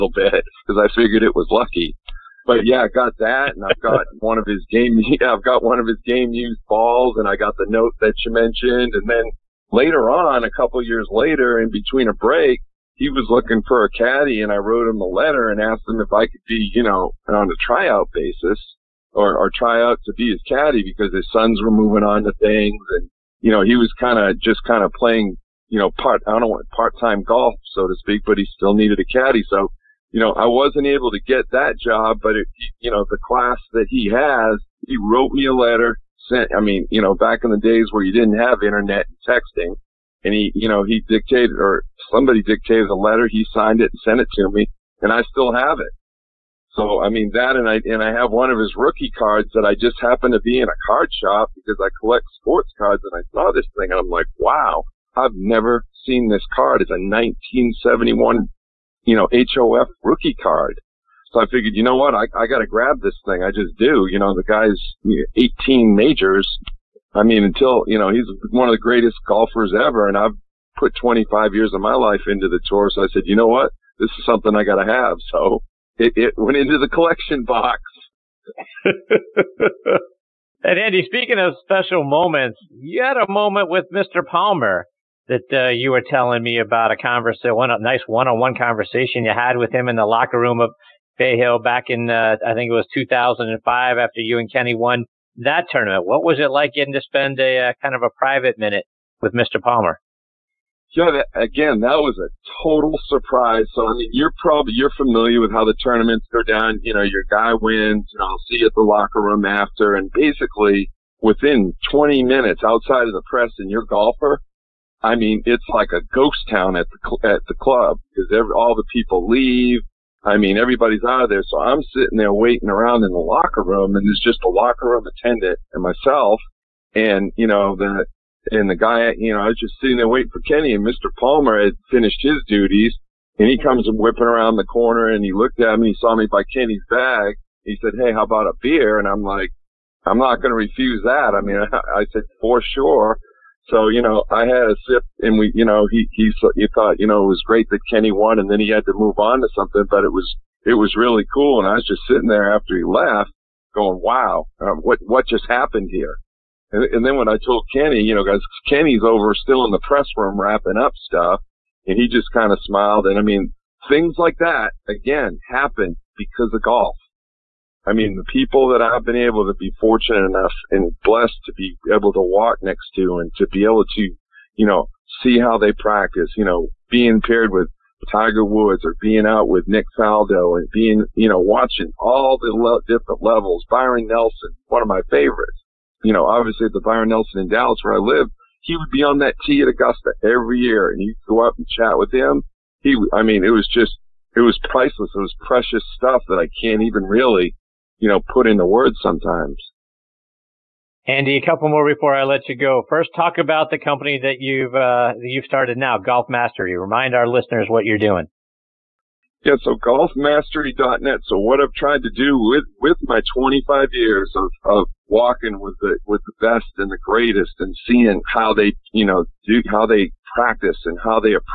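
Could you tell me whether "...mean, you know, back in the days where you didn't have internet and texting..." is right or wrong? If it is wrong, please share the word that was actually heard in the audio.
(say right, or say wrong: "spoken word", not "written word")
right.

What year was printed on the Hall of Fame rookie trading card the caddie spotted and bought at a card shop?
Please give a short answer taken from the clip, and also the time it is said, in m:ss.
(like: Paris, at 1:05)
1971, at 0:56.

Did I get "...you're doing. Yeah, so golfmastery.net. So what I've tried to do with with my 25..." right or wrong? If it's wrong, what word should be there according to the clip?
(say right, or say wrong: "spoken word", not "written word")
right.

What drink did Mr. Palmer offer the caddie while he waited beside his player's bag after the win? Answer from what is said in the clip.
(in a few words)
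A beer.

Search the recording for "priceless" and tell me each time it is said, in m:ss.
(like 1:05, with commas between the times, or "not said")
3:14.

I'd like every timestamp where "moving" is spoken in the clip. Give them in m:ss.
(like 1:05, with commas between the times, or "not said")
0:21.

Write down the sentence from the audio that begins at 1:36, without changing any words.
What was it like getting to spend a uh, kind of a private minute with Mr.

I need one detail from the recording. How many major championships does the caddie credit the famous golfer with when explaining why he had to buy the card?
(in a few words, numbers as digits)
18.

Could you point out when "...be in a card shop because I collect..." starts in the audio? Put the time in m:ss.
0:50.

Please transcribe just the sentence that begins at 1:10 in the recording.
And I've put 25 years of my life into the tour.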